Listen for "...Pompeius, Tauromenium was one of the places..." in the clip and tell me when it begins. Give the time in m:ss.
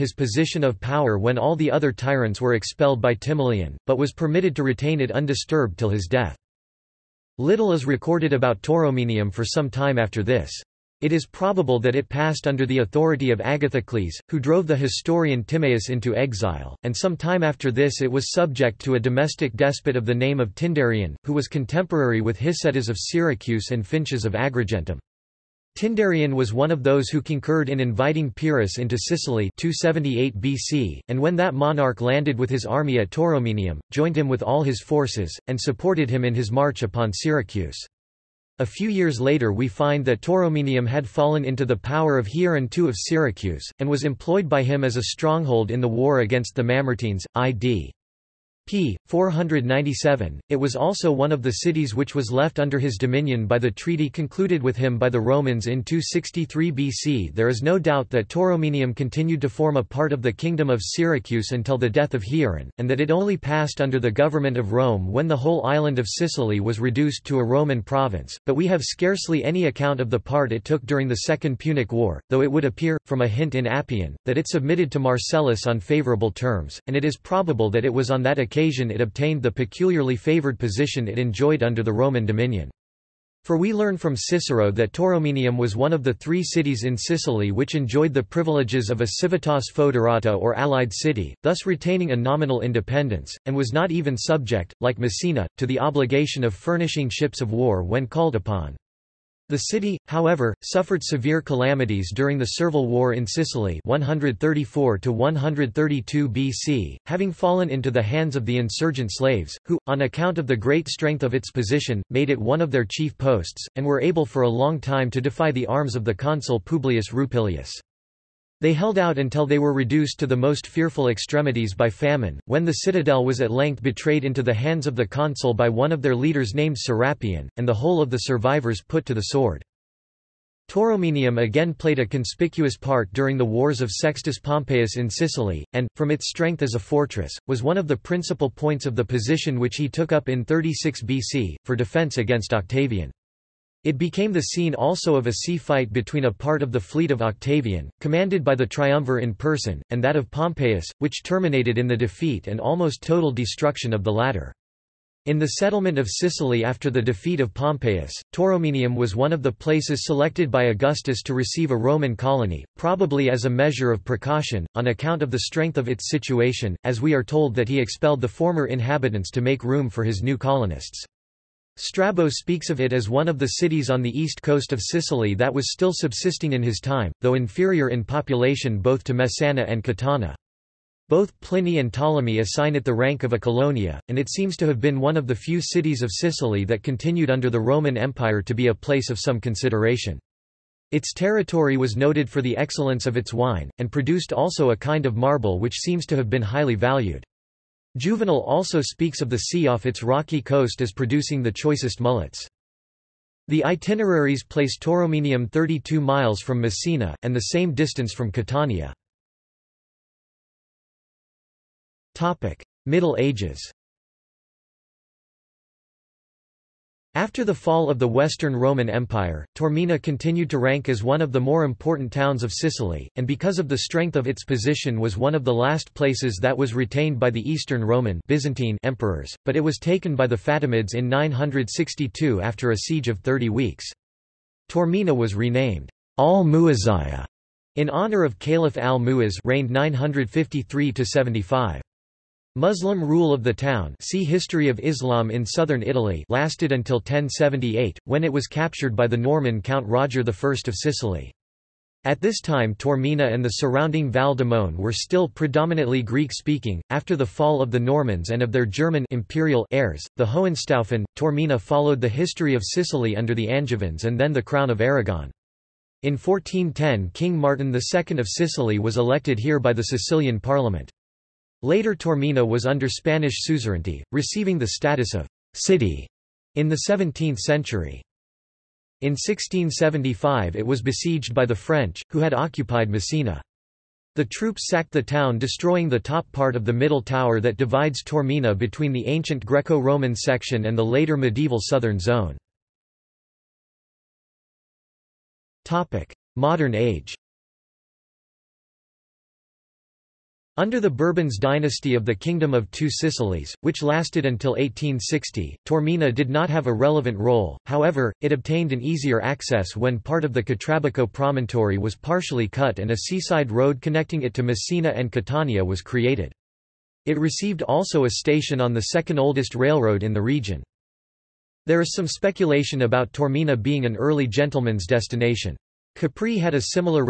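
2:37.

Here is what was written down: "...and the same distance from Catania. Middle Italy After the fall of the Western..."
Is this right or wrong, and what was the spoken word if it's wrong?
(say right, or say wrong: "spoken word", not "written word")
wrong: "Ages", not "Italy".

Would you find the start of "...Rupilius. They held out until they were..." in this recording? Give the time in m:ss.
1:57.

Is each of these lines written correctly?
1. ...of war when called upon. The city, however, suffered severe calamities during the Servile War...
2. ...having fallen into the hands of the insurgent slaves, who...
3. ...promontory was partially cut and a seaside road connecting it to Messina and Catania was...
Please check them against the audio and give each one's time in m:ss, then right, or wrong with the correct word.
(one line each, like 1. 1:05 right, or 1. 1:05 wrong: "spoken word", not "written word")
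1. 1:37 right
2. 1:47 right
3. 5:11 right.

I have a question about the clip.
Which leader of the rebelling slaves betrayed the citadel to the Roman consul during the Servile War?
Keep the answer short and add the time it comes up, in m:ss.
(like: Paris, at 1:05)
Serapion, at 2:06.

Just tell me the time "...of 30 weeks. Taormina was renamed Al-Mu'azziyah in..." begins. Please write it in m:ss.
3:53.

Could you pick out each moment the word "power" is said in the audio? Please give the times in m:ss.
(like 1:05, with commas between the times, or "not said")
0:00, 0:41.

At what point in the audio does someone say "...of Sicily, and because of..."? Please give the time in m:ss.
3:42.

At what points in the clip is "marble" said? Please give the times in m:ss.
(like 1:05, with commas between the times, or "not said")
3:15.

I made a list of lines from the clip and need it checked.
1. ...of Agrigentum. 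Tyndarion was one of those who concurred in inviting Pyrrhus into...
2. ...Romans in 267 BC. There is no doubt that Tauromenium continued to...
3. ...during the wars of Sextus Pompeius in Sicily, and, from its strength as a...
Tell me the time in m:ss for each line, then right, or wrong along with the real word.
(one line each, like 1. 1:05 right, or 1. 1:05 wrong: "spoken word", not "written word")
1. 0:24 right
2. 0:55 wrong: "263", not "267"
3. 2:13 right.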